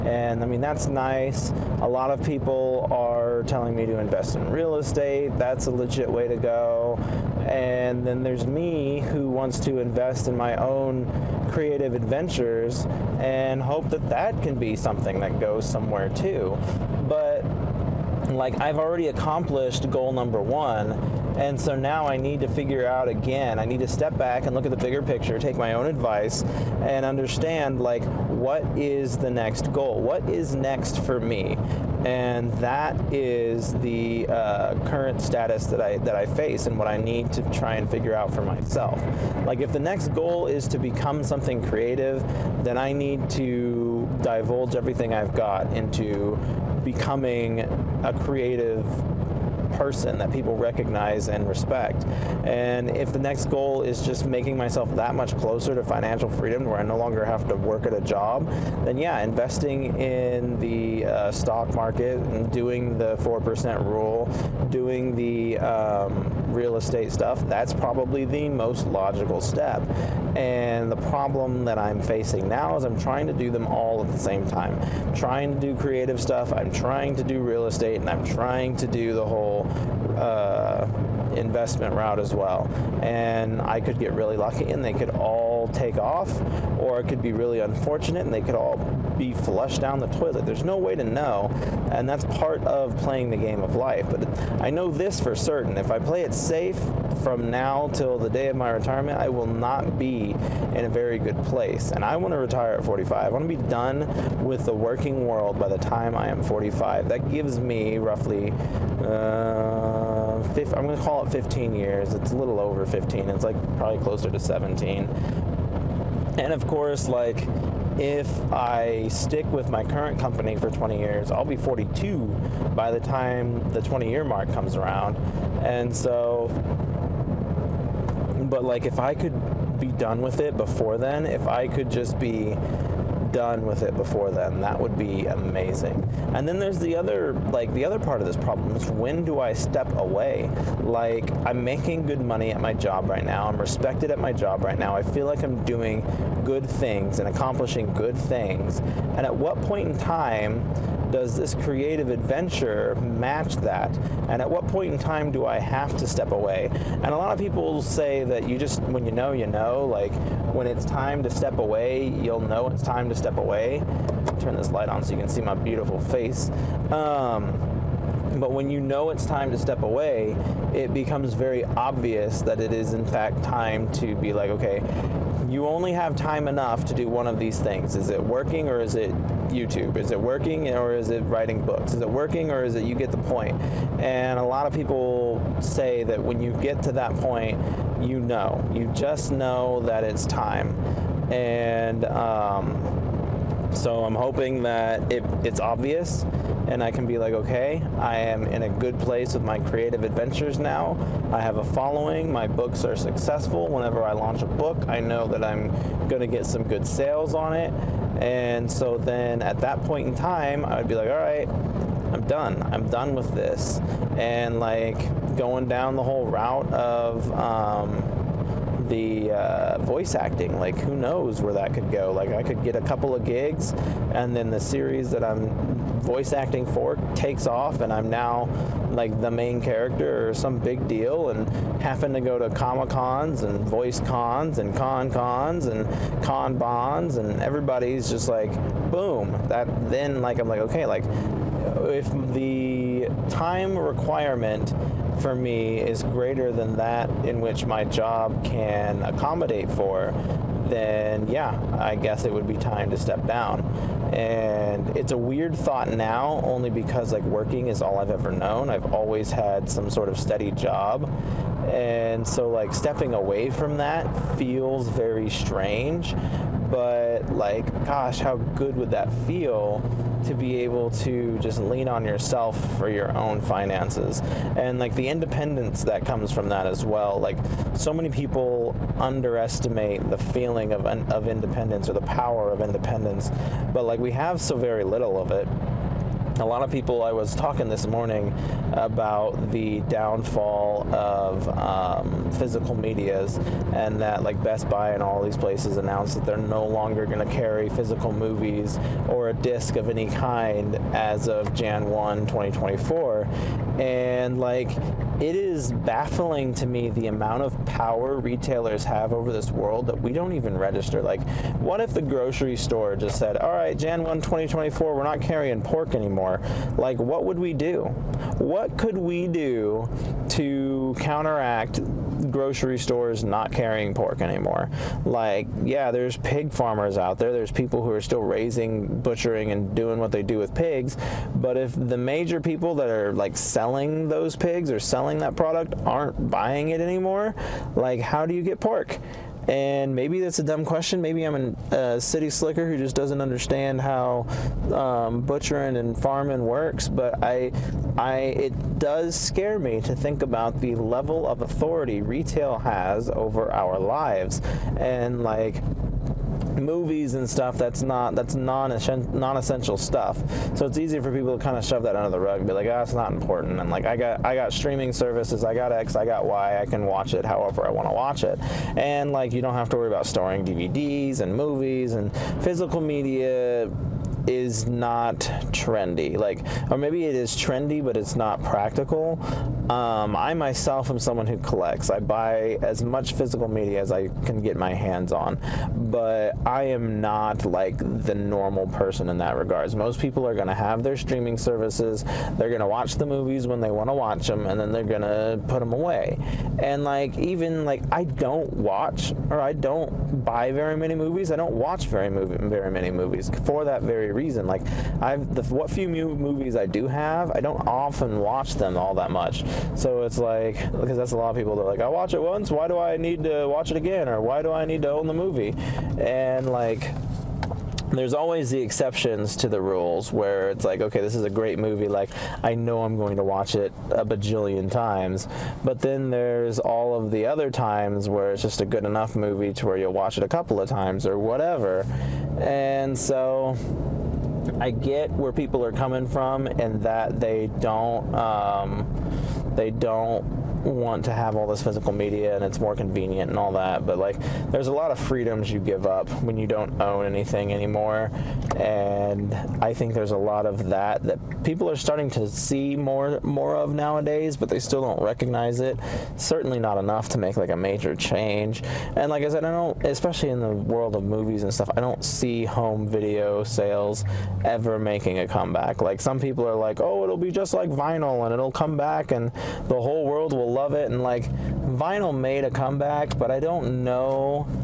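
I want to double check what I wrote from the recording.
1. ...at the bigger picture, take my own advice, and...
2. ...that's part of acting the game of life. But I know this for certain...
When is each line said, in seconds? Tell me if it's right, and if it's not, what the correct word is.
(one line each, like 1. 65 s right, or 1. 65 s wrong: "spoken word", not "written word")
1. 24 s right
2. 92 s wrong: "playing", not "acting".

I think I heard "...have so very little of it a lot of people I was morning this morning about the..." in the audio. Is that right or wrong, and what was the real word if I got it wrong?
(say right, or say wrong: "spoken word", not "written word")
wrong: "talking", not "morning".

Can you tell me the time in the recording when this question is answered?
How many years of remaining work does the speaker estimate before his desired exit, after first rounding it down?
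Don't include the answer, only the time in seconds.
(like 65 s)
111 s.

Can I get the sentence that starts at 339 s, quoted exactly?
And maybe that's a dumb question.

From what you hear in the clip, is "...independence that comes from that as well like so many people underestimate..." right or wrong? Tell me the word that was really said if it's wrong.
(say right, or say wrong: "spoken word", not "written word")
right.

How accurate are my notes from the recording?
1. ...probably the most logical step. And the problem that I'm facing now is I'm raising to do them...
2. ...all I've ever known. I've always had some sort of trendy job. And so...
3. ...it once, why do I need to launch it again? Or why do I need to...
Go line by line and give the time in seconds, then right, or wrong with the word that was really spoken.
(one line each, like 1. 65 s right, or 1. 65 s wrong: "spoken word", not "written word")
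1. 67 s wrong: "trying", not "raising"
2. 257 s wrong: "steady", not "trendy"
3. 412 s wrong: "watch", not "launch".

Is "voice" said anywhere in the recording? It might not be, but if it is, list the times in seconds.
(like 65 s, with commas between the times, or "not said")
219 s, 226 s, 233 s.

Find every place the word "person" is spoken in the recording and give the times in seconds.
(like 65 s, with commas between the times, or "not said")
49 s, 388 s.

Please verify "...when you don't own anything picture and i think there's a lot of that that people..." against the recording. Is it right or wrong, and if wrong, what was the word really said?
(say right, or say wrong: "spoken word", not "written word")
wrong: "anymore", not "picture".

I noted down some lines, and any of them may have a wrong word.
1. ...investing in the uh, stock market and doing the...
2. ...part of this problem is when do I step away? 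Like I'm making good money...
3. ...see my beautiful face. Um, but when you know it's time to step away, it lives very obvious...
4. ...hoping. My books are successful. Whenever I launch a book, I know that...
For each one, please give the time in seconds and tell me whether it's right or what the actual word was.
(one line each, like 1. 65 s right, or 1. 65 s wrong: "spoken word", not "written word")
1. 59 s right
2. 137 s right
3. 165 s wrong: "becomes", not "lives"
4. 201 s wrong: "following", not "hoping".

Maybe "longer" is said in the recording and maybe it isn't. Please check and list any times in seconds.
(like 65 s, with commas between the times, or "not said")
56 s, 296 s.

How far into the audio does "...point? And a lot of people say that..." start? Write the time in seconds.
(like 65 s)
183 s.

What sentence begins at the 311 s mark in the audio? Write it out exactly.
Like, what if the grocery store just said, all right, Jan 1, 2024, we're not carrying pork anymore?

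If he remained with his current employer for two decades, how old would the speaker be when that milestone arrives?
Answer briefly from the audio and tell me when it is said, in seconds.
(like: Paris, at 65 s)
42, at 121 s.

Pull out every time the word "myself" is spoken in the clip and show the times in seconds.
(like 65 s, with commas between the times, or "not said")
38 s, 54 s, 380 s.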